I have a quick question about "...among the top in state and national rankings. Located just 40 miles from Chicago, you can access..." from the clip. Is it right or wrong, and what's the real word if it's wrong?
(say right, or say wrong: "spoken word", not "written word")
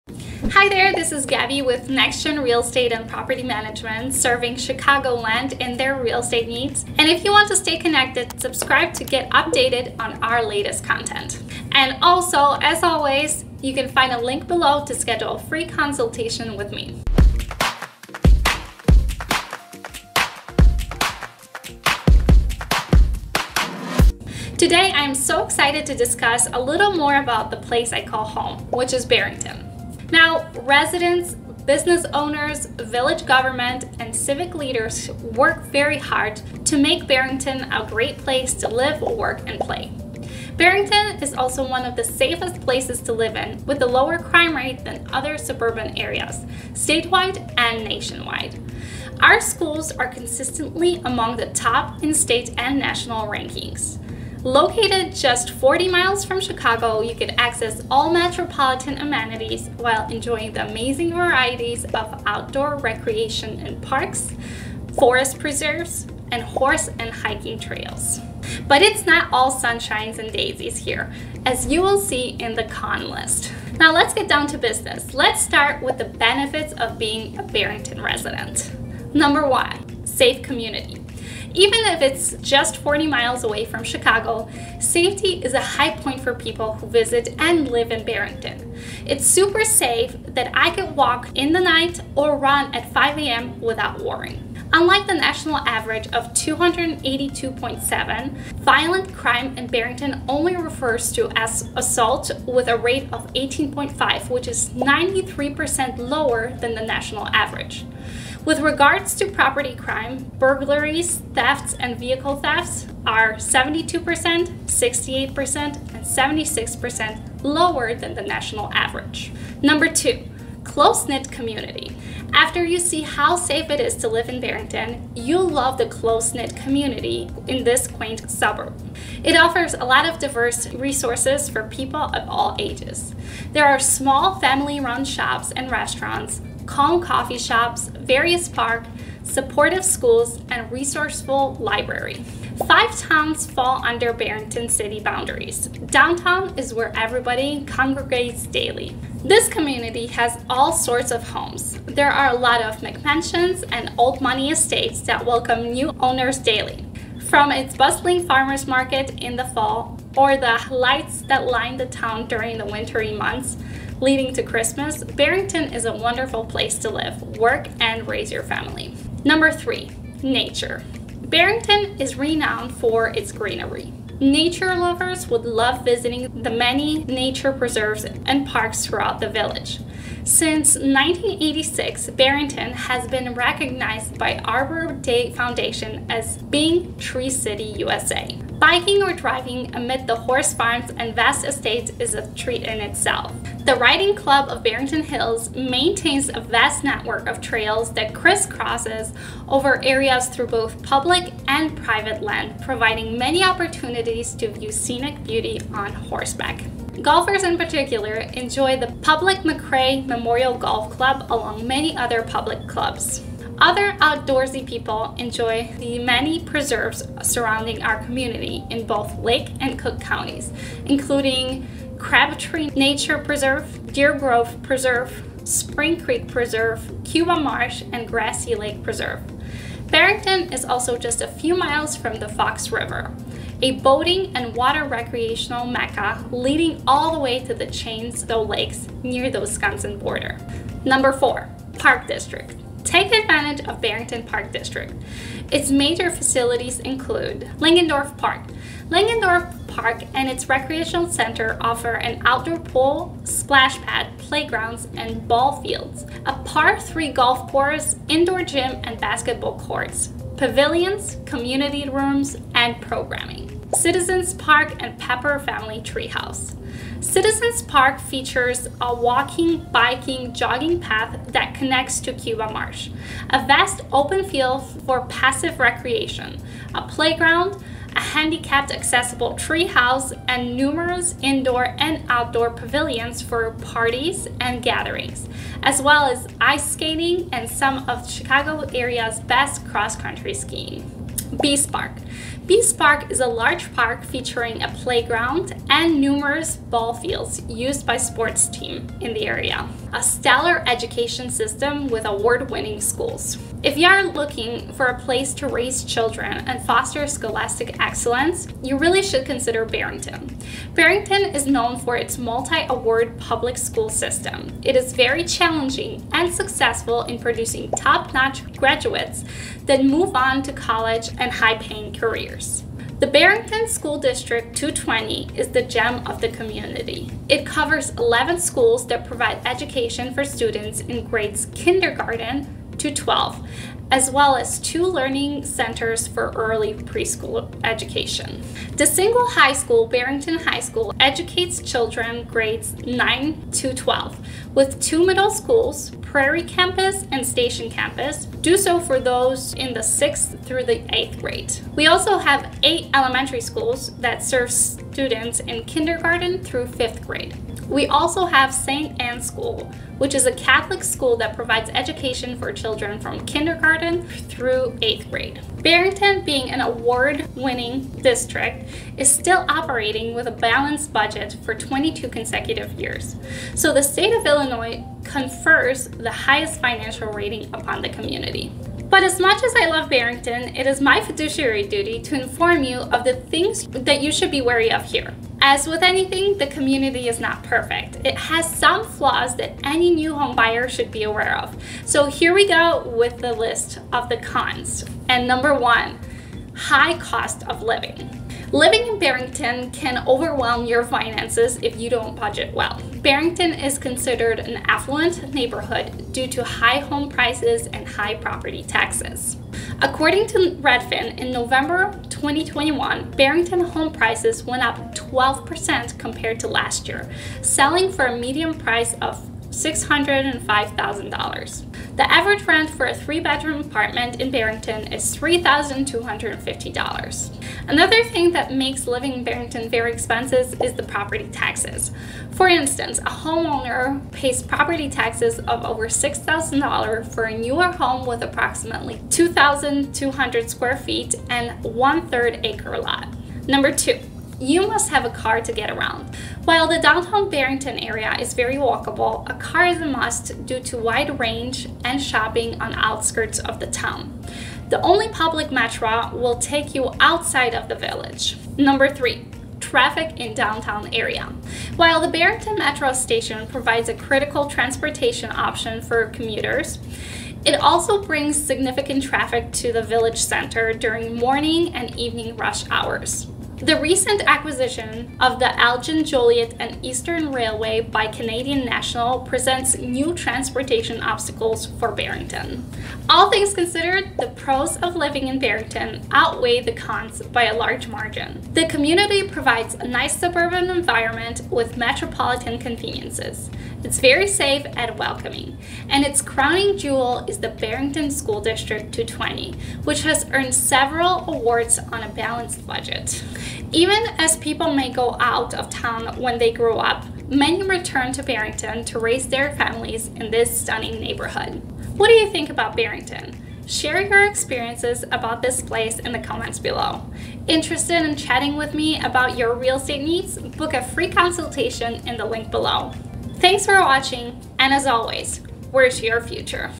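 right.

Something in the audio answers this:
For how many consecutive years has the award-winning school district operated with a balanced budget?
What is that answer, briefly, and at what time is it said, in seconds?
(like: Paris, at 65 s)
22, at 371 s.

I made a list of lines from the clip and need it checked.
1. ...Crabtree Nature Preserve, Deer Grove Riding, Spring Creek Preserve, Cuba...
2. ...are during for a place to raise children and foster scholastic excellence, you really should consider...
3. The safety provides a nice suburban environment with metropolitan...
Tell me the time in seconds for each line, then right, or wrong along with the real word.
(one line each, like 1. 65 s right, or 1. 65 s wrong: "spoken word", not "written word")
1. 222 s wrong: "Preserve", not "Riding"
2. 303 s wrong: "looking", not "during"
3. 488 s wrong: "community", not "safety".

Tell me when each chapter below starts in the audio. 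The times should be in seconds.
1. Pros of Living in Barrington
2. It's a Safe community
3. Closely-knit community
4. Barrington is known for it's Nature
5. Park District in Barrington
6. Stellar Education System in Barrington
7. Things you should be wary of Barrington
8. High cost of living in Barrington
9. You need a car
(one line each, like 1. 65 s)
1. 25 s
2. 79 s
3. 121 s
4. 170 s
5. 241 s
6. 302 s
7. 384 s
8. 396 s
9. 444 s.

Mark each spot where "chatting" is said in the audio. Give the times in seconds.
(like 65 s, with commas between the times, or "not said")
518 s.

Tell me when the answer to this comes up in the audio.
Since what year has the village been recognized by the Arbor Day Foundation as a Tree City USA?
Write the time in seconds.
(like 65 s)
180 s.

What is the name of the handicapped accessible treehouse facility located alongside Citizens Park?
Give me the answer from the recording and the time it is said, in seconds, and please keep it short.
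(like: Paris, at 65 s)
Pepper Family Treehouse, at 264 s.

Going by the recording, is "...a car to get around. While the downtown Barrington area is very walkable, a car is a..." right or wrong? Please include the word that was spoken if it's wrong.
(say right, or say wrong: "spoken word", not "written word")
right.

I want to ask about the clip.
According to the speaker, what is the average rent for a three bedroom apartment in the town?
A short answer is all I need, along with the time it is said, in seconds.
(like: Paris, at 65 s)
$3,250, at 425 s.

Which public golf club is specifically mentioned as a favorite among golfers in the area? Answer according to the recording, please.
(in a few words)
Makray Memorial Golf Club.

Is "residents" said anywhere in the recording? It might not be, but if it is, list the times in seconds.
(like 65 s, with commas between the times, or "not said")
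30 s, 78 s.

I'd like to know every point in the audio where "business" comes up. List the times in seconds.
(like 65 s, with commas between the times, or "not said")
31 s, 74 s.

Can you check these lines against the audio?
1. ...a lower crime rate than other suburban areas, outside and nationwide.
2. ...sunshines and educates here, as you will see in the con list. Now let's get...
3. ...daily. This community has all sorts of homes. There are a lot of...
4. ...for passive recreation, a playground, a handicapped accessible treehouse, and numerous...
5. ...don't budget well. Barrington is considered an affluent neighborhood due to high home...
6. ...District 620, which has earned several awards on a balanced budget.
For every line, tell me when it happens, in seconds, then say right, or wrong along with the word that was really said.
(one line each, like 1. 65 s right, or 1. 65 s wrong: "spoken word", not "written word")
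1. 43 s wrong: "statewide", not "outside"
2. 69 s wrong: "daisies", not "educates"
3. 148 s right
4. 274 s right
5. 401 s right
6. 498 s wrong: "220", not "620".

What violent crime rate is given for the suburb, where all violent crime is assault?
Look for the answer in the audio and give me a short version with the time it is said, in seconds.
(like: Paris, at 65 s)
18.5, at 103 s.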